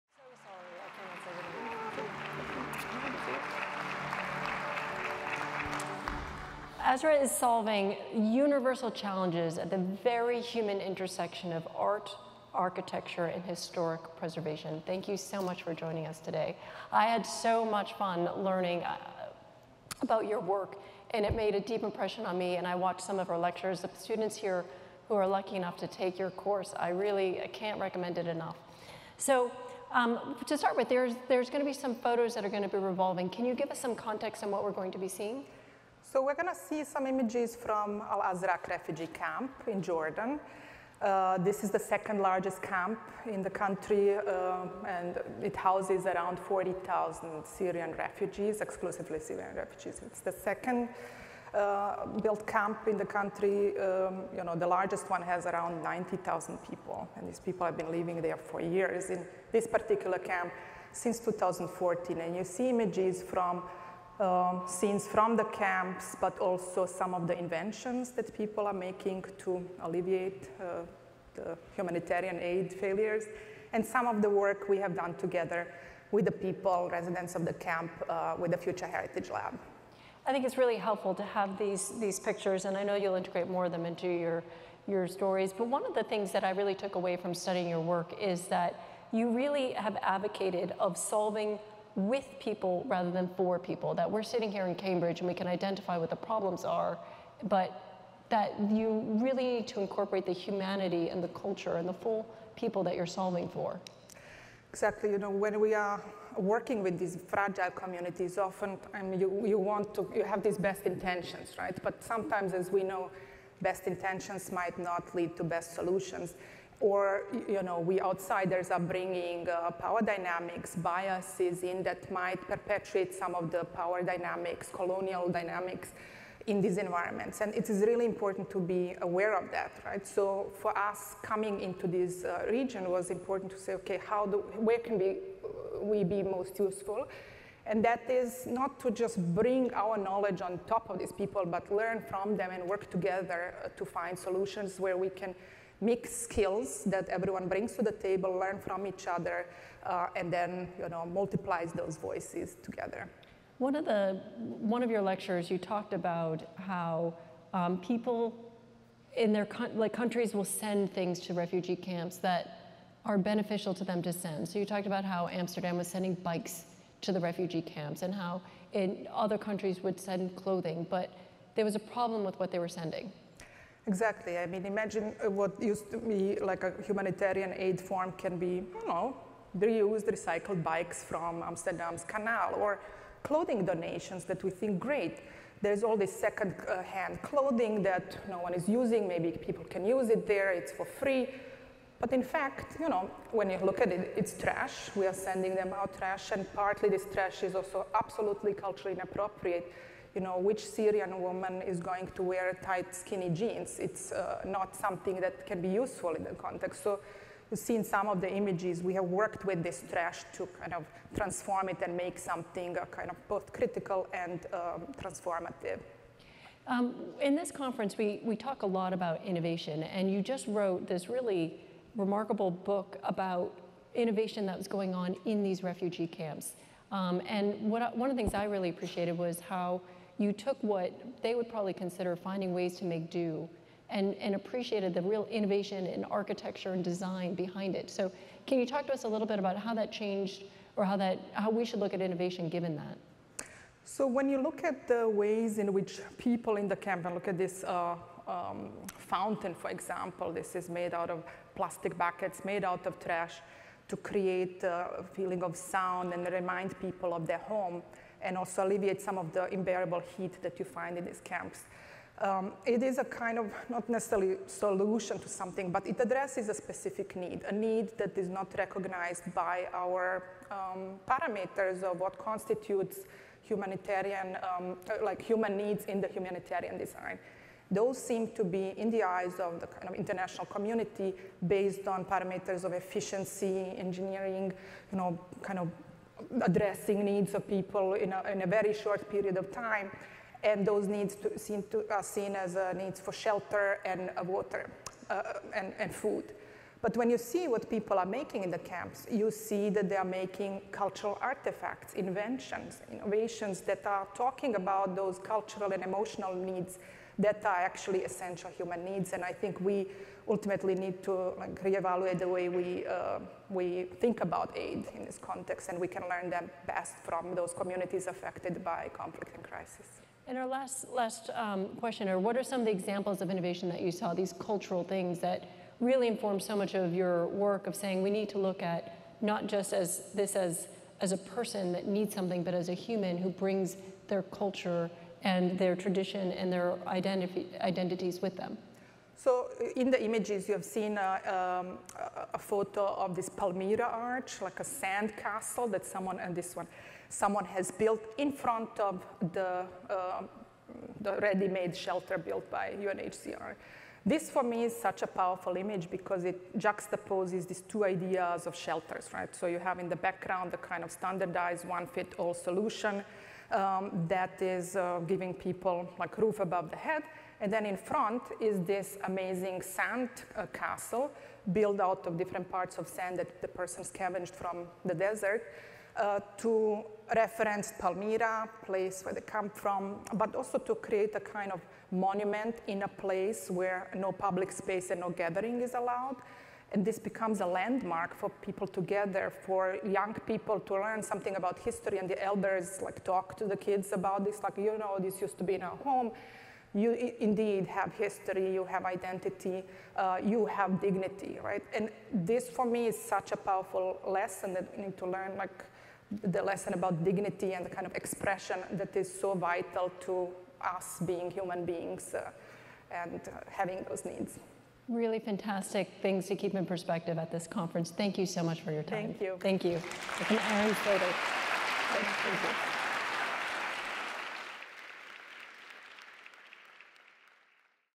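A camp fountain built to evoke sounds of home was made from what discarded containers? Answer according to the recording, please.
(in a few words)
Plastic buckets.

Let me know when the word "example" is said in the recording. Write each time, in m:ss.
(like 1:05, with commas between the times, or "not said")
4:09, 5:22.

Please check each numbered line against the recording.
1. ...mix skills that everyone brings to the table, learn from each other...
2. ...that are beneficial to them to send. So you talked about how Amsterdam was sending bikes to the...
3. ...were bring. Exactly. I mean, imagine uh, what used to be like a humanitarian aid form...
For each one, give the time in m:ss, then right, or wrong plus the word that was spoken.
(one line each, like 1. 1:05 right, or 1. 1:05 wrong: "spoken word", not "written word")
1. 2:25 right
2. 2:42 right
3. 2:52 wrong: "sending", not "bring".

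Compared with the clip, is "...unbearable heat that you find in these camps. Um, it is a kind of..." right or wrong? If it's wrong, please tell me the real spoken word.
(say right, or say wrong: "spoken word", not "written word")
right.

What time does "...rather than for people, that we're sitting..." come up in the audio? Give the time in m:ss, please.
1:32.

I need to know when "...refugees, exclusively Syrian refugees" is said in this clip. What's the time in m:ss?
0:47.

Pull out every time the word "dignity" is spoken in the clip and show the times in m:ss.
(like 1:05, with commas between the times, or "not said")
6:40, 6:47.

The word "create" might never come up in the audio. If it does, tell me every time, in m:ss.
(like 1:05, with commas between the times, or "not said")
4:13, 6:20.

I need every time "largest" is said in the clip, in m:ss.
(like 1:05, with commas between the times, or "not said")
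0:42, 0:54.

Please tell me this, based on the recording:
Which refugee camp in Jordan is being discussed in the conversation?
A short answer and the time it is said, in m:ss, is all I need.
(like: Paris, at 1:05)
Al-Azraq, at 0:38.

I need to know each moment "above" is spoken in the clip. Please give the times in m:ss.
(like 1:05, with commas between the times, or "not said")
6:06.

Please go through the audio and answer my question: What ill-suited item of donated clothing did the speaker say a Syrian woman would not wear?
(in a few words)
Tight skinny jeans.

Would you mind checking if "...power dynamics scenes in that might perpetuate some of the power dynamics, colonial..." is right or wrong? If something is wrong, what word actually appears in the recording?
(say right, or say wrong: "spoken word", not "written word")
wrong: "biases", not "scenes".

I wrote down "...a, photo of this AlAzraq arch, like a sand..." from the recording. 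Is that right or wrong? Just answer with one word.
wrong.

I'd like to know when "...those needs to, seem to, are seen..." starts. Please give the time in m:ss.
4:50.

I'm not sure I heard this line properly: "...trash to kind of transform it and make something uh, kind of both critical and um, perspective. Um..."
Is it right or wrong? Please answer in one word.
wrong.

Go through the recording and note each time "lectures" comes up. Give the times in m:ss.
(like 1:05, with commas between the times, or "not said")
0:23, 2:35.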